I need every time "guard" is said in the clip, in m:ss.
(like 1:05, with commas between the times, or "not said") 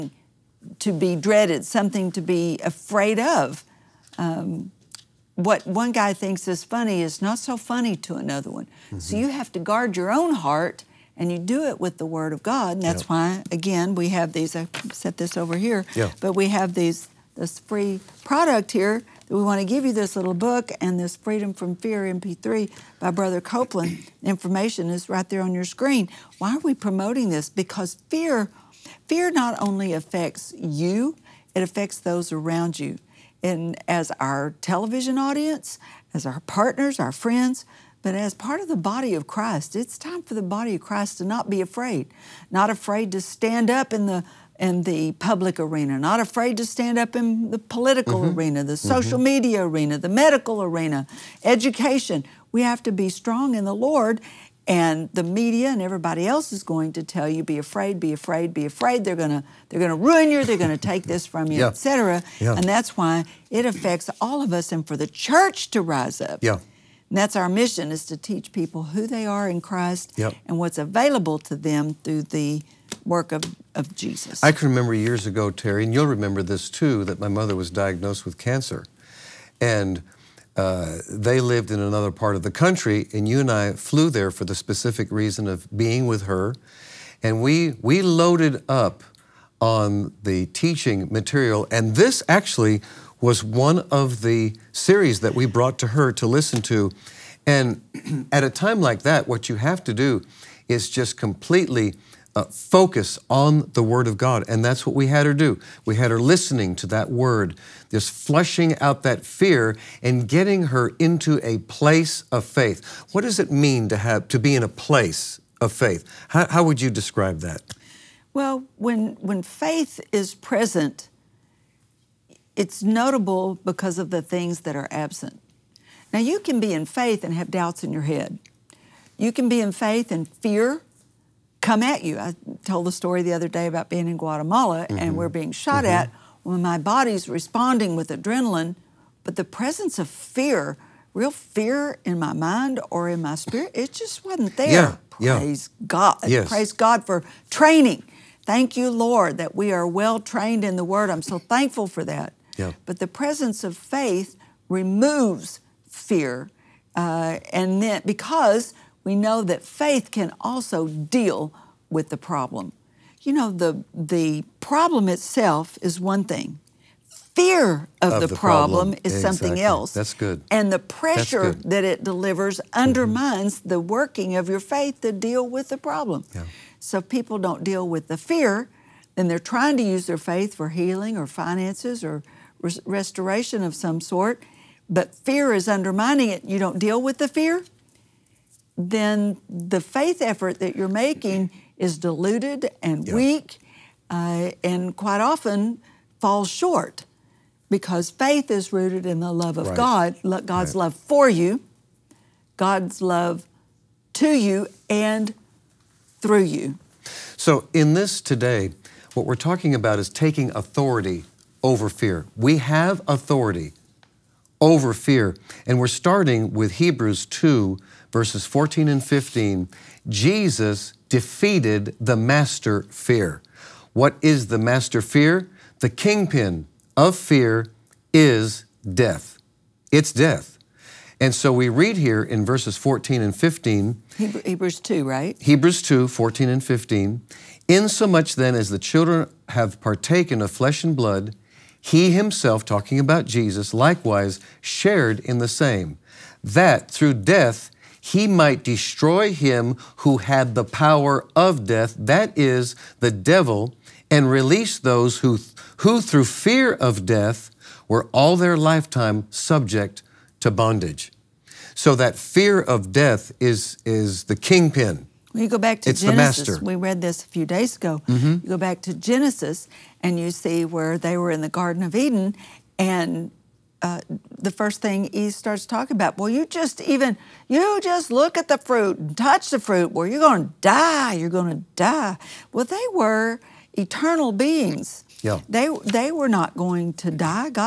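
0:09.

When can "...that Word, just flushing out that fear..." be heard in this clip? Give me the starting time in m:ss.
1:46.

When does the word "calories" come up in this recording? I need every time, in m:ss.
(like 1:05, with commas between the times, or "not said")
not said.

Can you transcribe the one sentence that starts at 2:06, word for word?
Now, you can be in faith and have doubts in your head.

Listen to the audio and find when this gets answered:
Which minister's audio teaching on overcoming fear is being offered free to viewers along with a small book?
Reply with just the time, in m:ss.
0:23.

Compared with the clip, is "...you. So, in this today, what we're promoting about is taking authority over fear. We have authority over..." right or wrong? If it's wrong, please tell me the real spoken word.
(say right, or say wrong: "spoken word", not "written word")
wrong: "talking", not "promoting".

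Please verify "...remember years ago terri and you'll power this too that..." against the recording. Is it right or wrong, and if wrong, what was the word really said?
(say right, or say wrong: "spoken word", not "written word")
wrong: "remember", not "power".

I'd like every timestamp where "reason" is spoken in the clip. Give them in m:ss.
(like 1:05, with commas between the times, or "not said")
1:25.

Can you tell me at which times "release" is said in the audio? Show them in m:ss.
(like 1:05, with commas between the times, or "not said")
4:14.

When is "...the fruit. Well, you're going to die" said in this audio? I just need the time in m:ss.
4:39.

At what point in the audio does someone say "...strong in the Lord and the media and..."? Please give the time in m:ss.
0:53.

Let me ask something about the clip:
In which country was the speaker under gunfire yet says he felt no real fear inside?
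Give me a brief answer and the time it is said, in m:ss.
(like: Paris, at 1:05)
Guatemala, at 2:14.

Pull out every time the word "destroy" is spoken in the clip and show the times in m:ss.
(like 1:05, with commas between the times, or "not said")
4:08.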